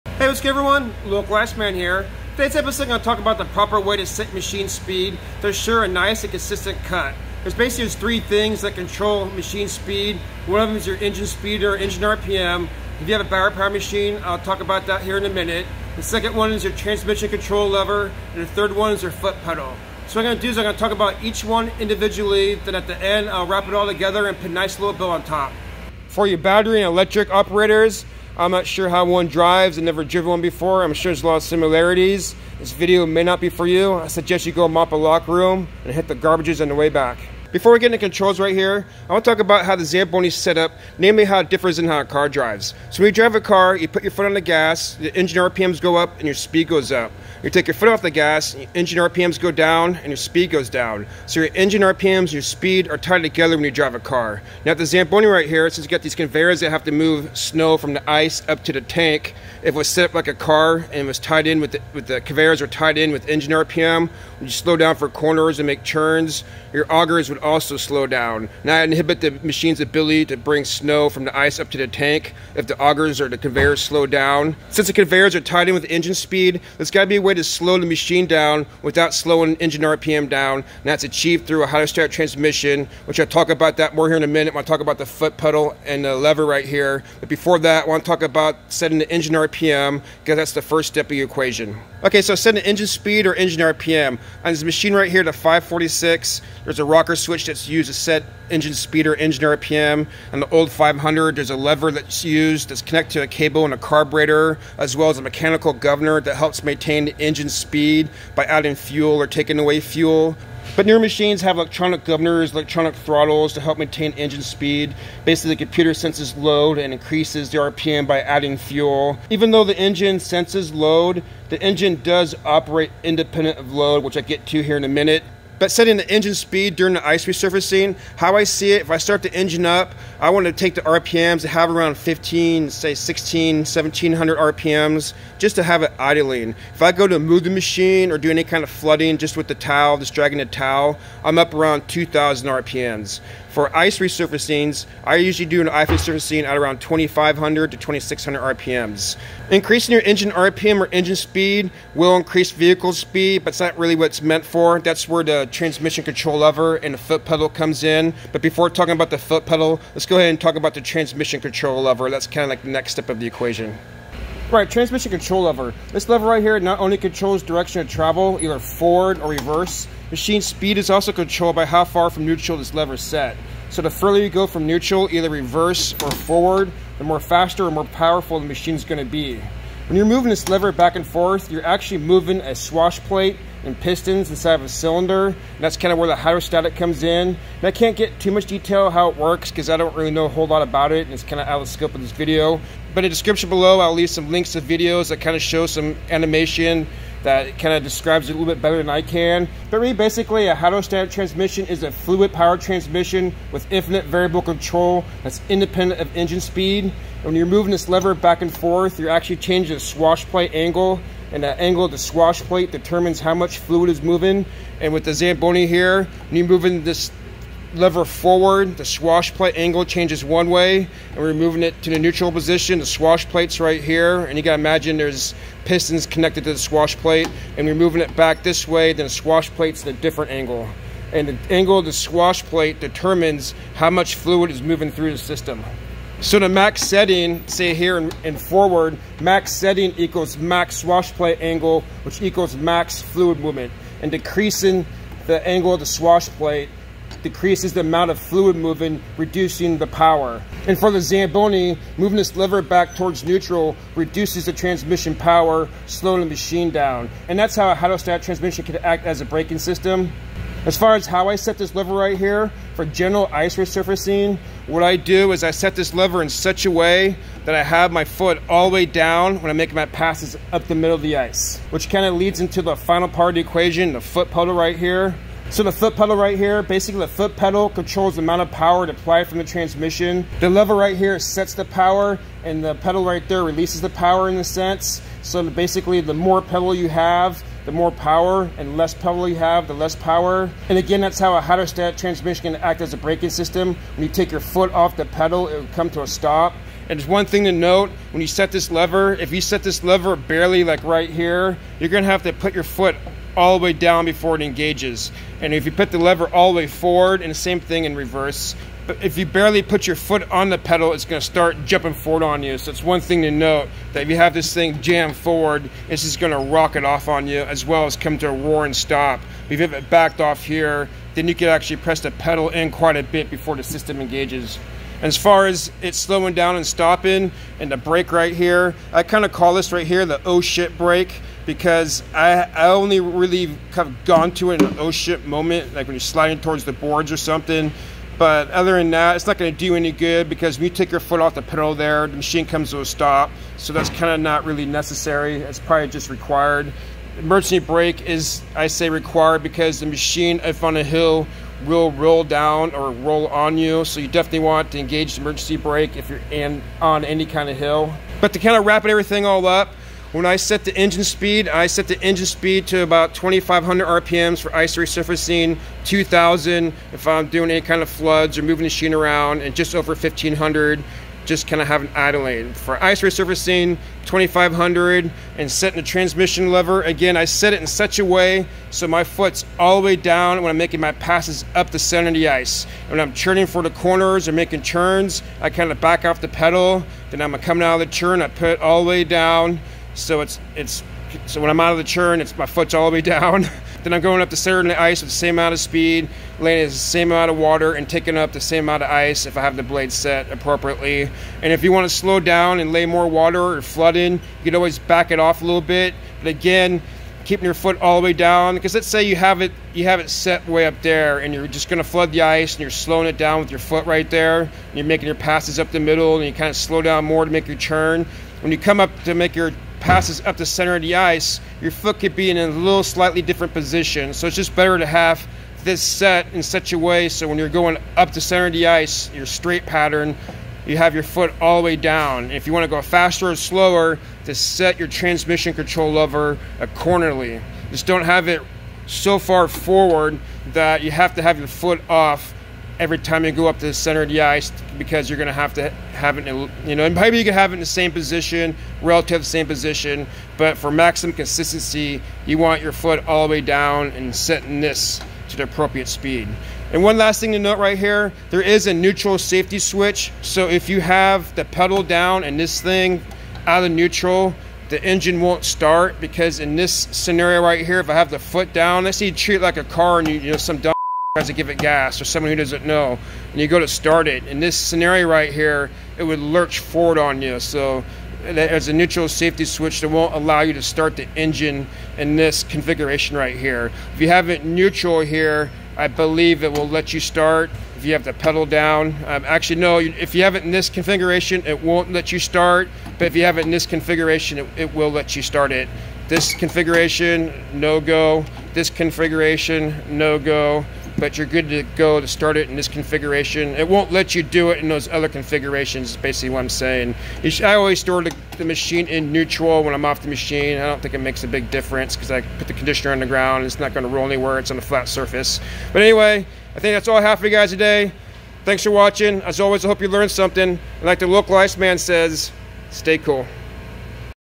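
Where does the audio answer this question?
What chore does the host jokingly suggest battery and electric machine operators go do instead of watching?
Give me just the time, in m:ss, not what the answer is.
0:34.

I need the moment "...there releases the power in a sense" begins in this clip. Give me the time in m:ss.
4:43.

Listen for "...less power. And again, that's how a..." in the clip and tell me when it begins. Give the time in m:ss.
4:49.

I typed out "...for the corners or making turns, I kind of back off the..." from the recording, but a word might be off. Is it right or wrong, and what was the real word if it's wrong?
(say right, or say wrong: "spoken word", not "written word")
right.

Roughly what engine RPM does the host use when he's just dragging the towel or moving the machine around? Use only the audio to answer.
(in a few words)
2000 RPMs.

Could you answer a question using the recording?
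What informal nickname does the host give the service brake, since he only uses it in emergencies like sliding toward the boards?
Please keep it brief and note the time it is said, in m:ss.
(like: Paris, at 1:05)
the oh shit brake, at 5:30.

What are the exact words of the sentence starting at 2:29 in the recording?
Increasing your engine RPM or engine speed will increase vehicle speed, but it's not really what it's meant for.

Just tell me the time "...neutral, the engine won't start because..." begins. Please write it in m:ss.
7:43.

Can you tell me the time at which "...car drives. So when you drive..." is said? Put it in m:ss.
0:42.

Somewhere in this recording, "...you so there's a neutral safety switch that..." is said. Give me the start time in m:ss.
7:57.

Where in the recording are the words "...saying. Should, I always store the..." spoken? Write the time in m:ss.
8:26.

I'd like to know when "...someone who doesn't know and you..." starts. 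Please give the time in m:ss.
7:52.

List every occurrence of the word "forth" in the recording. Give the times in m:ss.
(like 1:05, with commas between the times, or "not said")
3:01, 3:28.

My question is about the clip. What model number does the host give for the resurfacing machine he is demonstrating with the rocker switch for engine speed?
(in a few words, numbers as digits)
546.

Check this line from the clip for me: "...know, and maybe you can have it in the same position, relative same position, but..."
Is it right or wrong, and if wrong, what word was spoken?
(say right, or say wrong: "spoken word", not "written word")
right.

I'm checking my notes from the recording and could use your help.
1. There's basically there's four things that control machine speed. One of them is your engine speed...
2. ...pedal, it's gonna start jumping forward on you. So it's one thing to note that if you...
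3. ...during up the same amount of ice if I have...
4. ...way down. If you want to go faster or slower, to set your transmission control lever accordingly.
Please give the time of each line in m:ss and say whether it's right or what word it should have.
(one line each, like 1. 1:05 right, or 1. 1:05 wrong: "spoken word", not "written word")
1. 0:07 wrong: "three", not "four"
2. 5:10 right
3. 6:37 wrong: "taking", not "during"
4. 7:11 right.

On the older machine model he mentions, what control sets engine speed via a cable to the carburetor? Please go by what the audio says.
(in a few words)
a lever.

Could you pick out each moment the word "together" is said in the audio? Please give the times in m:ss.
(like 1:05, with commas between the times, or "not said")
0:23, 0:53.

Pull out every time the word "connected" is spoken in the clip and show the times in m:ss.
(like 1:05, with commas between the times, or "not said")
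1:42, 3:46.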